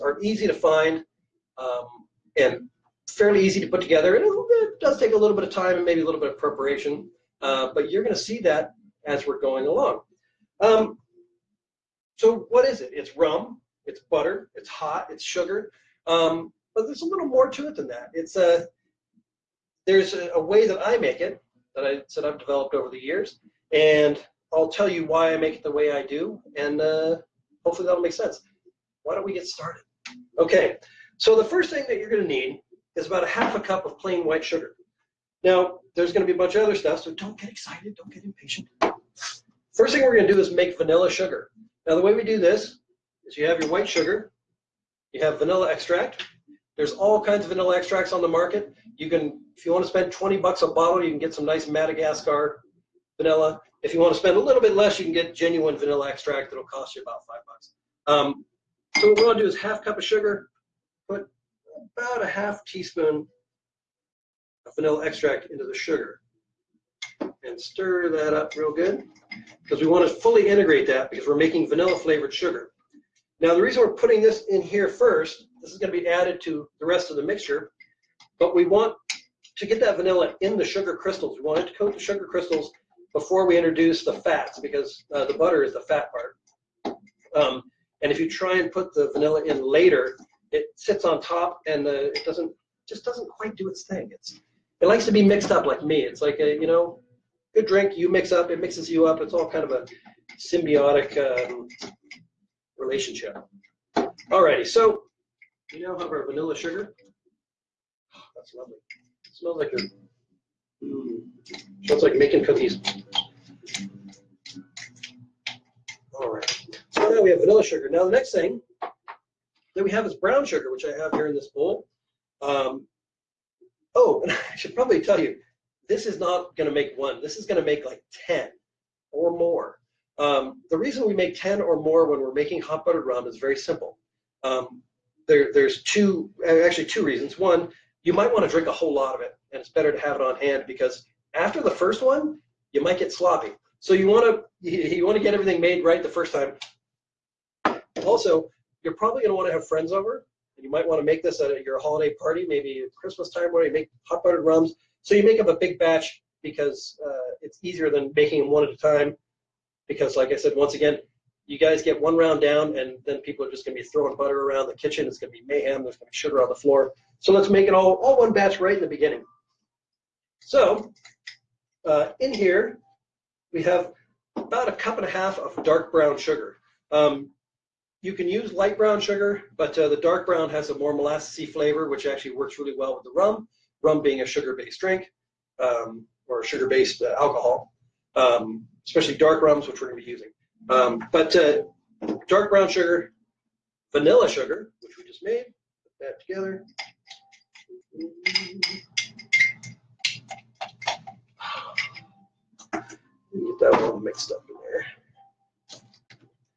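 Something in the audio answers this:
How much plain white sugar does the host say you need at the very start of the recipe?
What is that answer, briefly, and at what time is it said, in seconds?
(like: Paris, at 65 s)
half a cup, at 33 s.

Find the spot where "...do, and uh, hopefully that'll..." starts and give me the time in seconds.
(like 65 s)
26 s.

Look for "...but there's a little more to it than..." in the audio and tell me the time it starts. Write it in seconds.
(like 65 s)
16 s.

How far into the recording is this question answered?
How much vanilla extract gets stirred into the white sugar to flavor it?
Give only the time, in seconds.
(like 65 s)
62 s.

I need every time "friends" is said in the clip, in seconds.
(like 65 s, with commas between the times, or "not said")
149 s.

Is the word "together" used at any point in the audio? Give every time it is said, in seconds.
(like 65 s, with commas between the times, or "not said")
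3 s, 196 s.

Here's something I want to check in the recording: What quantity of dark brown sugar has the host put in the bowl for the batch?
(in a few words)
1.5 cups.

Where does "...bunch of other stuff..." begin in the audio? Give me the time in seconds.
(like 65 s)
36 s.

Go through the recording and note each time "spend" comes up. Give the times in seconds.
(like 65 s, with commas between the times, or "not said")
49 s, 54 s.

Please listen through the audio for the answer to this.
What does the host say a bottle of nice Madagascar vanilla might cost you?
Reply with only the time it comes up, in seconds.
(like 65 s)
50 s.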